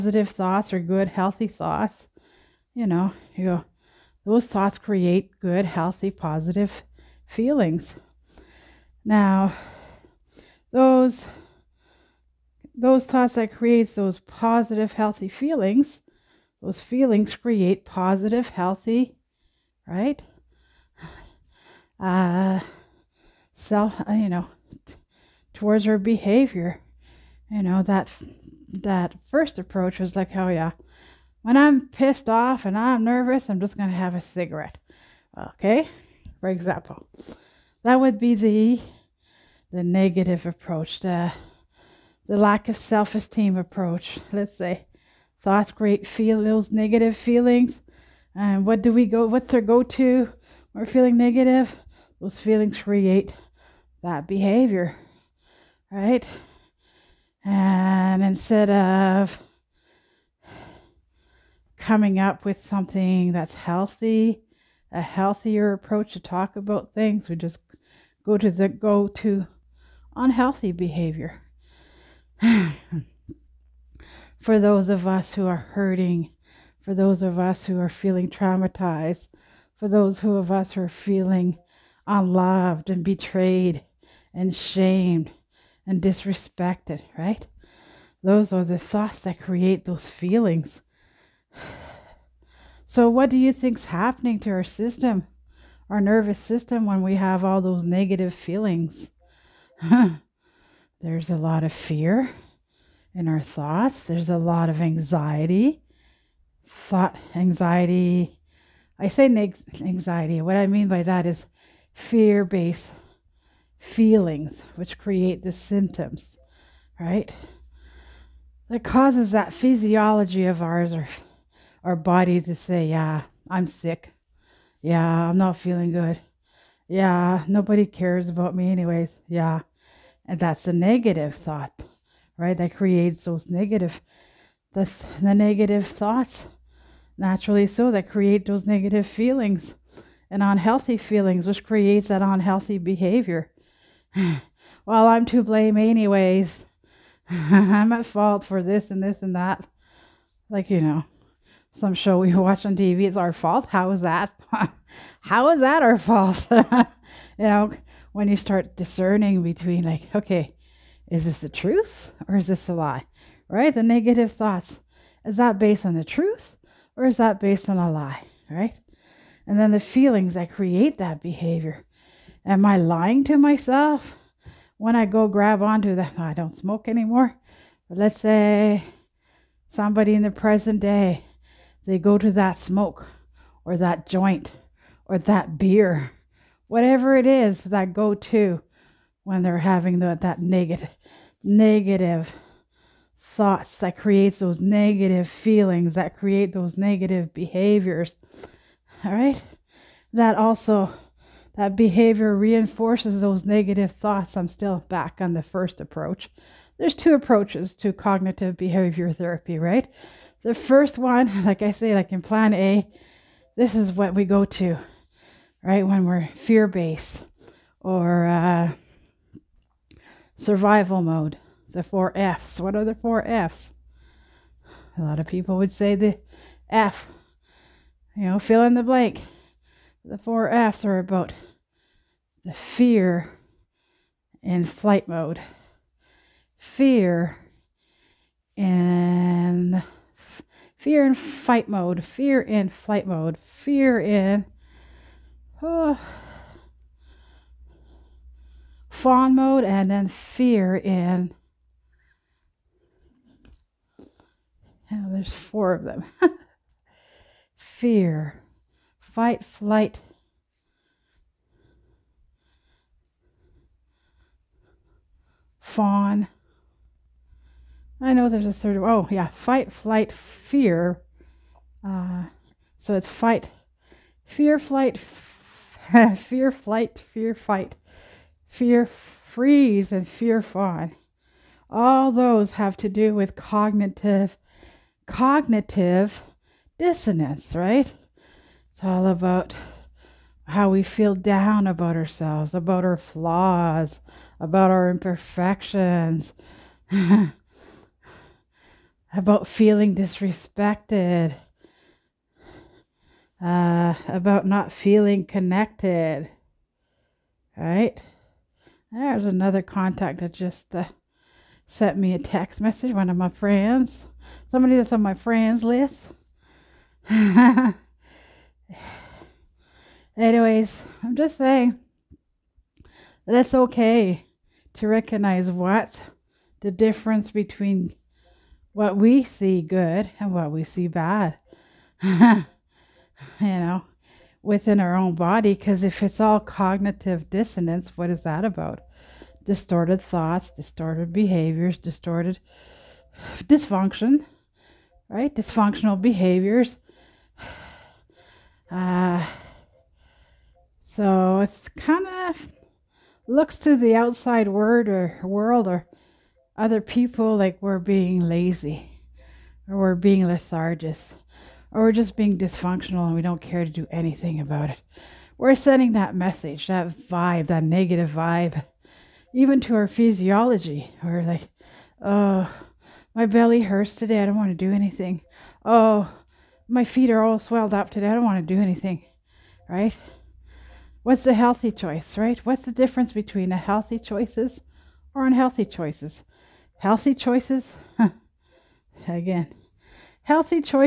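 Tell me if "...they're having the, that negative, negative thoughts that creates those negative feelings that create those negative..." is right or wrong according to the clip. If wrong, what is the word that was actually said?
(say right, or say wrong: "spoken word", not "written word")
right.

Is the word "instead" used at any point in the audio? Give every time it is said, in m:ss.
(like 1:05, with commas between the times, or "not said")
0:58.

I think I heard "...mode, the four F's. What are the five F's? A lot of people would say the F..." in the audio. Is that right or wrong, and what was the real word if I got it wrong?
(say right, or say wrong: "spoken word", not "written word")
wrong: "four", not "five".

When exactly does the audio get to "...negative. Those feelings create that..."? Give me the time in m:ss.
0:51.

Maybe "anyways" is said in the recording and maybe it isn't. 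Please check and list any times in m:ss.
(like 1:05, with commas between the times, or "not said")
2:08, 2:25, 5:20.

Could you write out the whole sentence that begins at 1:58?
That causes that physiology of ours, or our body to say, yeah, I'm sick.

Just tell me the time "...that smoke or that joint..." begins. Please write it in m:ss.
3:02.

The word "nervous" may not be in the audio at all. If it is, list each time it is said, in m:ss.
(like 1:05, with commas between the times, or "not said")
0:33, 1:35.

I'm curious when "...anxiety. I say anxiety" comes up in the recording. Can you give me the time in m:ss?
1:47.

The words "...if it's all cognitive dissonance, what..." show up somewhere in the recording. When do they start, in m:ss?
5:35.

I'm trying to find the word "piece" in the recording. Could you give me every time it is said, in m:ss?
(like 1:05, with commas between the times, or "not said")
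not said.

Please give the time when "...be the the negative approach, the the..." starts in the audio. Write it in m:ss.
0:38.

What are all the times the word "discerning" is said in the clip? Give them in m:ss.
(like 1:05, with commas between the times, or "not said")
2:38.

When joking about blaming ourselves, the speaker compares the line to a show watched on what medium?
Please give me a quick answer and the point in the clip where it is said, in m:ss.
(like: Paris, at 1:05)
TV, at 2:32.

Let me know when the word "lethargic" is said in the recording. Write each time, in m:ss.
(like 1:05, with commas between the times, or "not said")
6:00.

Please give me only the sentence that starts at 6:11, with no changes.
We're like, oh, my belly hurts today.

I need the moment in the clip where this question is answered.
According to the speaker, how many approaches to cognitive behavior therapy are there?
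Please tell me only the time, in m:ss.
3:26.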